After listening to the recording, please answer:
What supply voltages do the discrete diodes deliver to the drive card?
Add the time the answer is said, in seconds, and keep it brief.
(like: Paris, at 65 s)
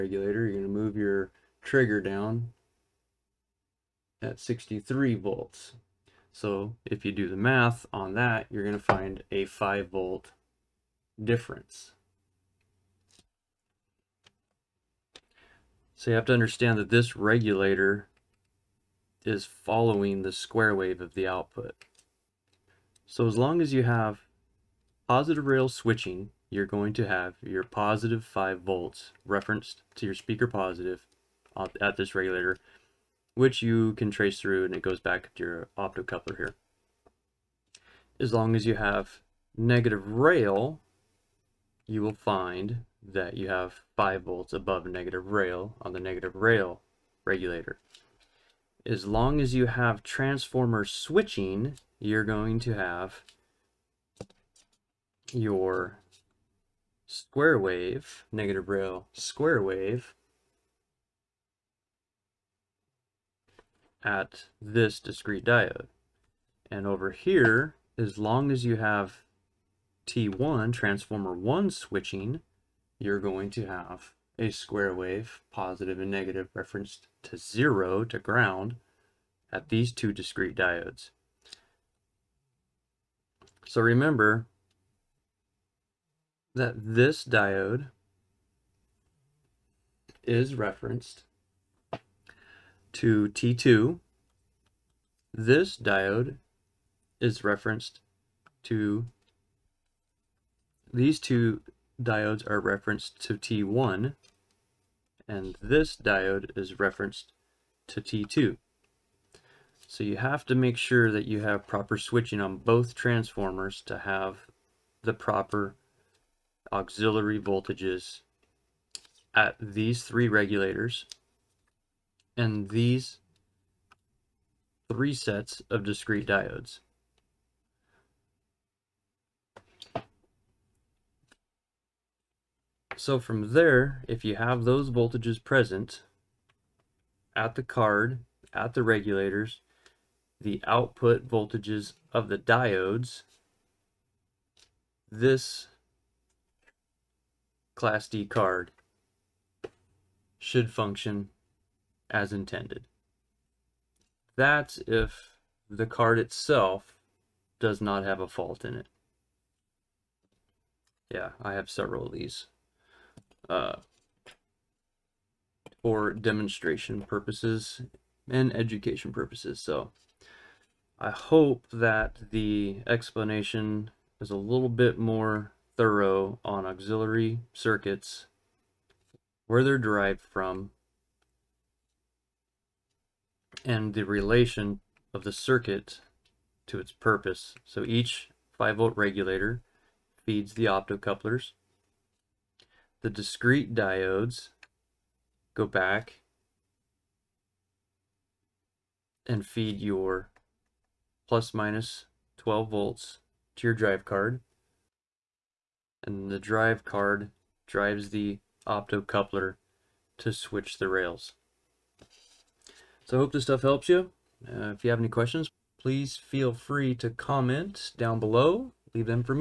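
plus/minus 12 volts, at 201 s.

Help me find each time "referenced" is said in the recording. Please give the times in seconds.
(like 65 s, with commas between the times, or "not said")
29 s, 76 s, 90 s, 97 s, 102 s, 106 s.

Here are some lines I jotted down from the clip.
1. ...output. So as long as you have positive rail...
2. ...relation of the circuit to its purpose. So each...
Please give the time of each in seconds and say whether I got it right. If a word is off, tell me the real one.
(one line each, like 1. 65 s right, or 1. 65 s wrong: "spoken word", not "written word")
1. 21 s right
2. 184 s right.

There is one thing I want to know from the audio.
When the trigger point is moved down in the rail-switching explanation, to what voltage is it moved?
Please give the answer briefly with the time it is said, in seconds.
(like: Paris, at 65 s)
63 volts, at 4 s.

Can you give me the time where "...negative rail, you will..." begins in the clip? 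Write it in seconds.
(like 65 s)
39 s.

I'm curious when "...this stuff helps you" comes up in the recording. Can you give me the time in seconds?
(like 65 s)
213 s.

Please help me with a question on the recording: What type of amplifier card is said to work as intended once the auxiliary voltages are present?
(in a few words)
Class D.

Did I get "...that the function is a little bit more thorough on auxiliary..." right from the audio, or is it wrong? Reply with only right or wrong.
wrong.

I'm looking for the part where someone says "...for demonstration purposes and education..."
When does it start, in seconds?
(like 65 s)
165 s.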